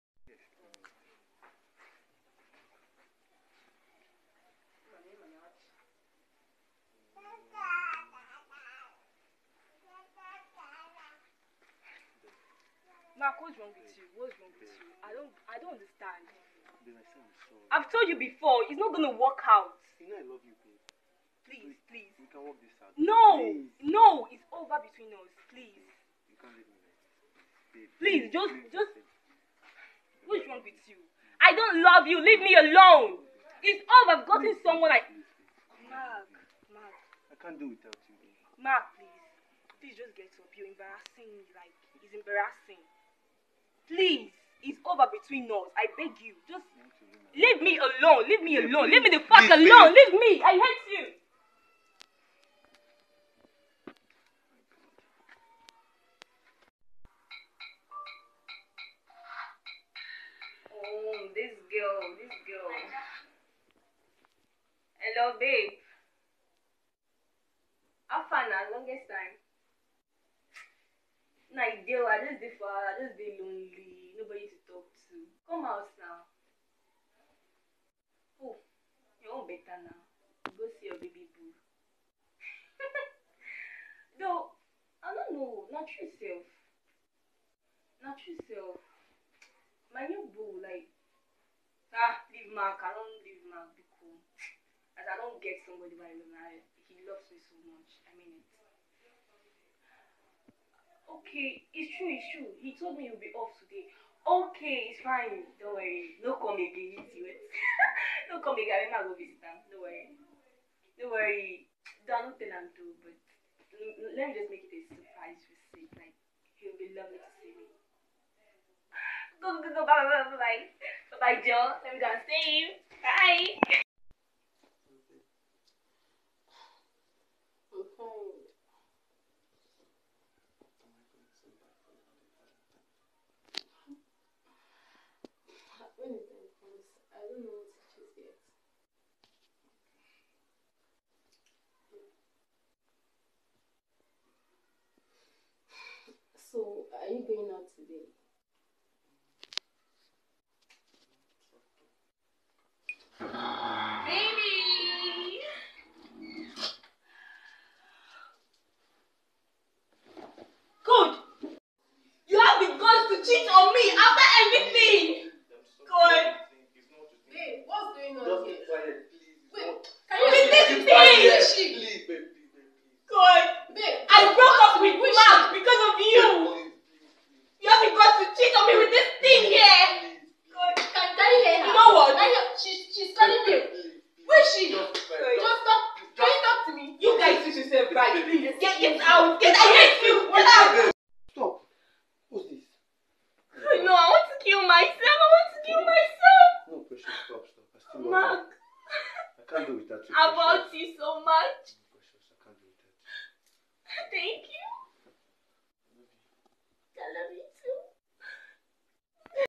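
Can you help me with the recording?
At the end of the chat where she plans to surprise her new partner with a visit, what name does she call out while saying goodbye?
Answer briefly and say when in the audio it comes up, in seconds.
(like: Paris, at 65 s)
Joe, at 121 s.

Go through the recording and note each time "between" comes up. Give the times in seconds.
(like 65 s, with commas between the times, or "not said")
24 s, 45 s.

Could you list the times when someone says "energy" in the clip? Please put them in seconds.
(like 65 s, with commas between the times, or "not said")
not said.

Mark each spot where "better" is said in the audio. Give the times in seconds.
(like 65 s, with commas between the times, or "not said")
79 s.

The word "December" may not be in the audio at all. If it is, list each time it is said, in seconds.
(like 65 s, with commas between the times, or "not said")
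not said.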